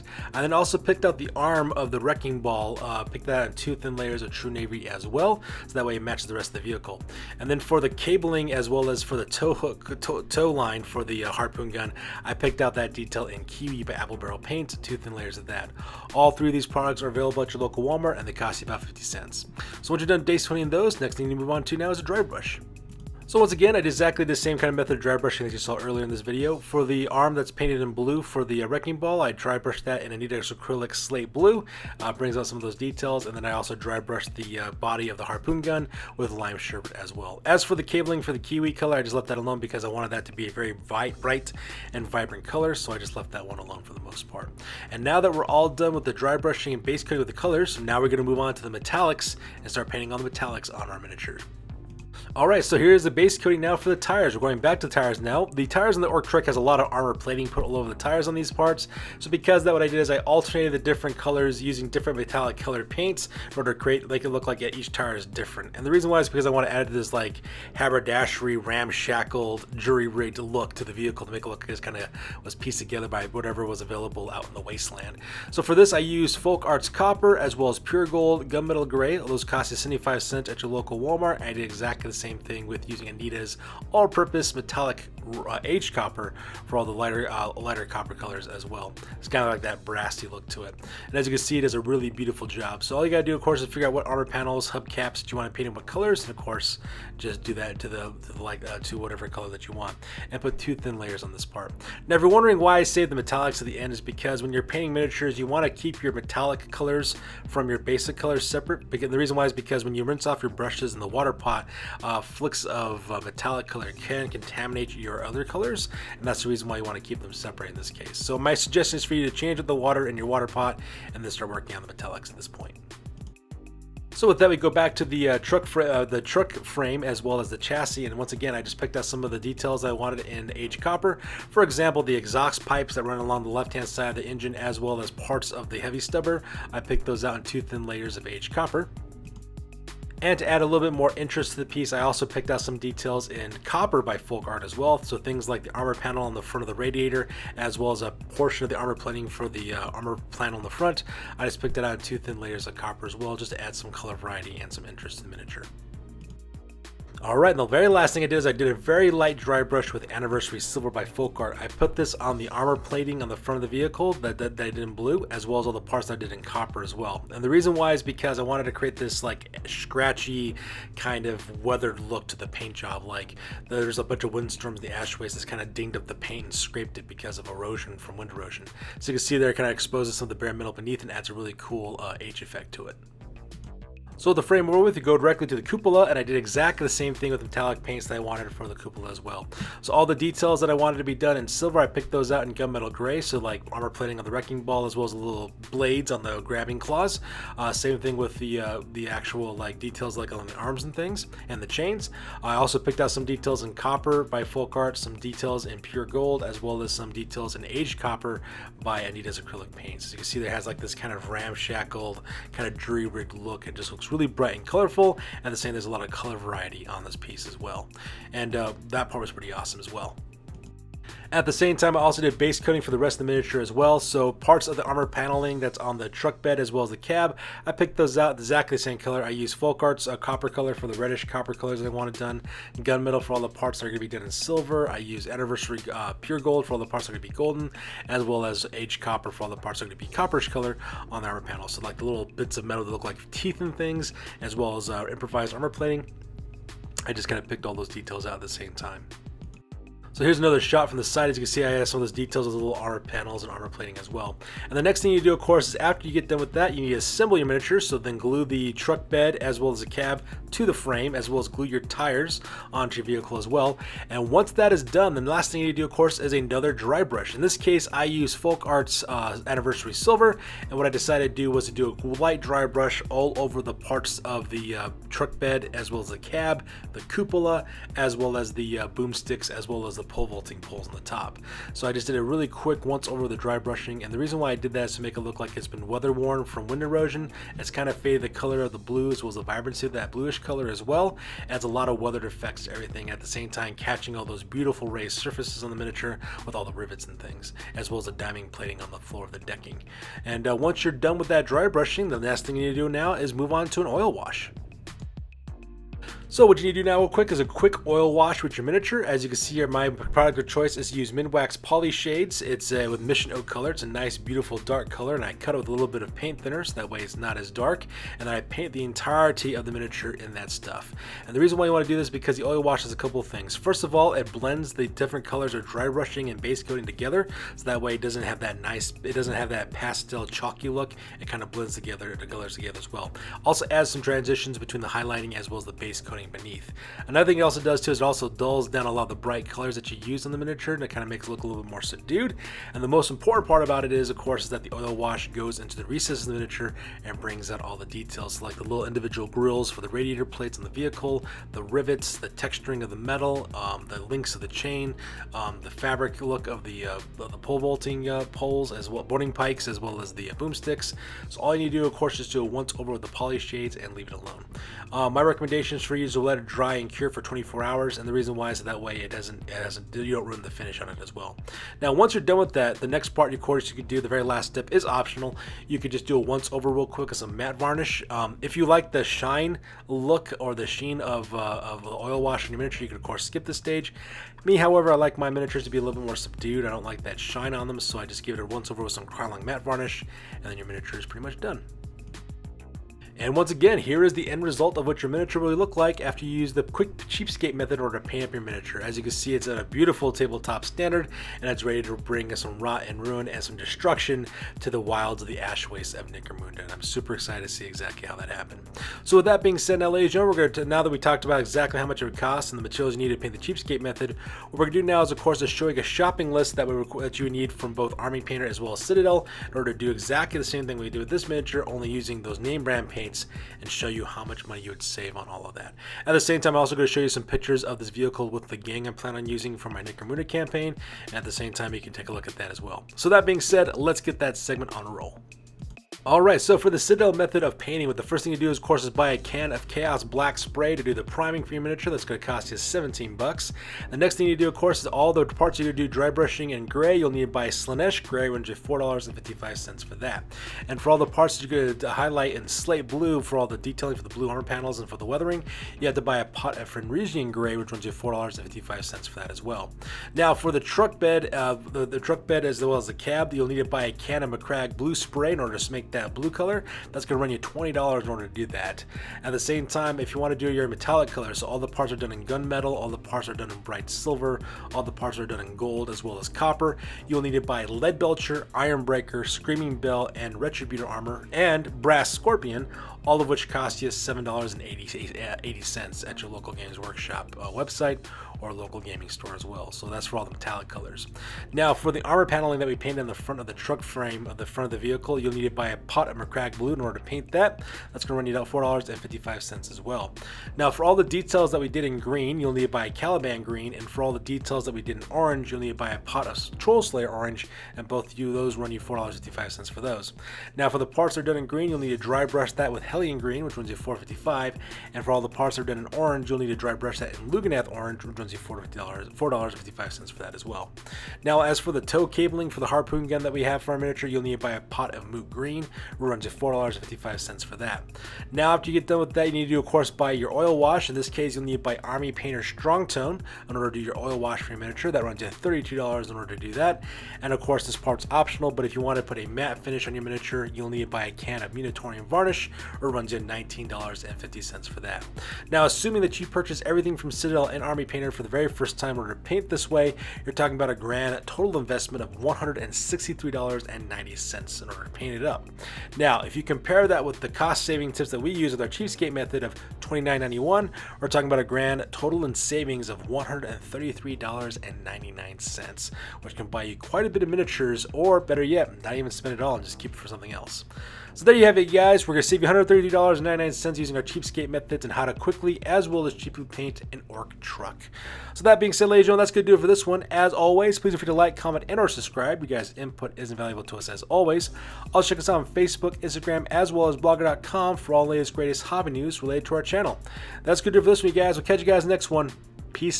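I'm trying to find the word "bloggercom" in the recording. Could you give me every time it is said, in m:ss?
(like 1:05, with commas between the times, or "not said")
9:46.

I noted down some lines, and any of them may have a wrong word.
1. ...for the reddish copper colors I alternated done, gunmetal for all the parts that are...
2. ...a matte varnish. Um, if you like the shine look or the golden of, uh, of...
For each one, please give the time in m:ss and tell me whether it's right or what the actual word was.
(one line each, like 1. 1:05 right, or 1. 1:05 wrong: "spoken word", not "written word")
1. 3:50 wrong: "wanted", not "alternated"
2. 6:17 wrong: "sheen", not "golden".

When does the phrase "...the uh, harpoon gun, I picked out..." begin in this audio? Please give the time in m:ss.
0:11.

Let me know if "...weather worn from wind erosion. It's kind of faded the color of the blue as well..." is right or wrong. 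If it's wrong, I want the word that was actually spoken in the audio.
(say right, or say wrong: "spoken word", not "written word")
right.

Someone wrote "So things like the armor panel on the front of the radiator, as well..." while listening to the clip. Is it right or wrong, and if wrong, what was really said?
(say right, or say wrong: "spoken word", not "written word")
right.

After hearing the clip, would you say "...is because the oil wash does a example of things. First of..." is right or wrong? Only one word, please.
wrong.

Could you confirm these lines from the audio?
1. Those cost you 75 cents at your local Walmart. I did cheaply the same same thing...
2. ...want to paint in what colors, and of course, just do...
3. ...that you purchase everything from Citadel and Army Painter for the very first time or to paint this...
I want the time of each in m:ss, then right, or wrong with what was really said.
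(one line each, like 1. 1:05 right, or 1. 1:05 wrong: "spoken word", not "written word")
1. 1:19 wrong: "exactly", not "cheaply"
2. 1:35 right
3. 9:06 right.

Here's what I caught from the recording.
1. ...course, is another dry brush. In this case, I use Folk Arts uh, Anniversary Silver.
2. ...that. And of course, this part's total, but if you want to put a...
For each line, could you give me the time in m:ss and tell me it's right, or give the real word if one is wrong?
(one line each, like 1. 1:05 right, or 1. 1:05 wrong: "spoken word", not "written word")
1. 4:25 right
2. 8:56 wrong: "optional", not "total".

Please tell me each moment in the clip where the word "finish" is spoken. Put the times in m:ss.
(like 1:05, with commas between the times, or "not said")
6:10, 8:59.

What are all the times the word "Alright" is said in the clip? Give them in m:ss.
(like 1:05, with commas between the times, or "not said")
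0:52, 2:37, 7:16.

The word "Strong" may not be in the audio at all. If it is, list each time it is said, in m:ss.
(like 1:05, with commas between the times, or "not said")
8:52.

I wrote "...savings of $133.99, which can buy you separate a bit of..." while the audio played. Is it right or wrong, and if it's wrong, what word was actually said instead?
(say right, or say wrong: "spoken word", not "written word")
wrong: "quite", not "separate".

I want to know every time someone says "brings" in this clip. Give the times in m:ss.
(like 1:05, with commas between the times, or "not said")
0:32, 5:47, 6:41.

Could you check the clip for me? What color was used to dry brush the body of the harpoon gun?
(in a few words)
Lime sherbet.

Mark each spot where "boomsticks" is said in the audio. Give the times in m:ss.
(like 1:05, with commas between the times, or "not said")
4:38, 6:00.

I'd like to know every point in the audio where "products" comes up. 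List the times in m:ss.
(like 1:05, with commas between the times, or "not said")
0:16, 5:09.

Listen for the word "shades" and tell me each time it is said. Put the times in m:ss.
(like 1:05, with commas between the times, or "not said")
5:11, 6:03.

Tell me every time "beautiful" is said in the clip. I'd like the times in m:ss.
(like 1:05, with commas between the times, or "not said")
1:32, 4:54, 5:14, 6:39.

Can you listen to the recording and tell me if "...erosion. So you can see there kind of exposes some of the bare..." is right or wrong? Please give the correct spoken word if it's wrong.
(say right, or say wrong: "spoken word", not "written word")
right.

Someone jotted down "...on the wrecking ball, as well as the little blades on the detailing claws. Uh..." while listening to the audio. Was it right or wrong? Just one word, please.
wrong.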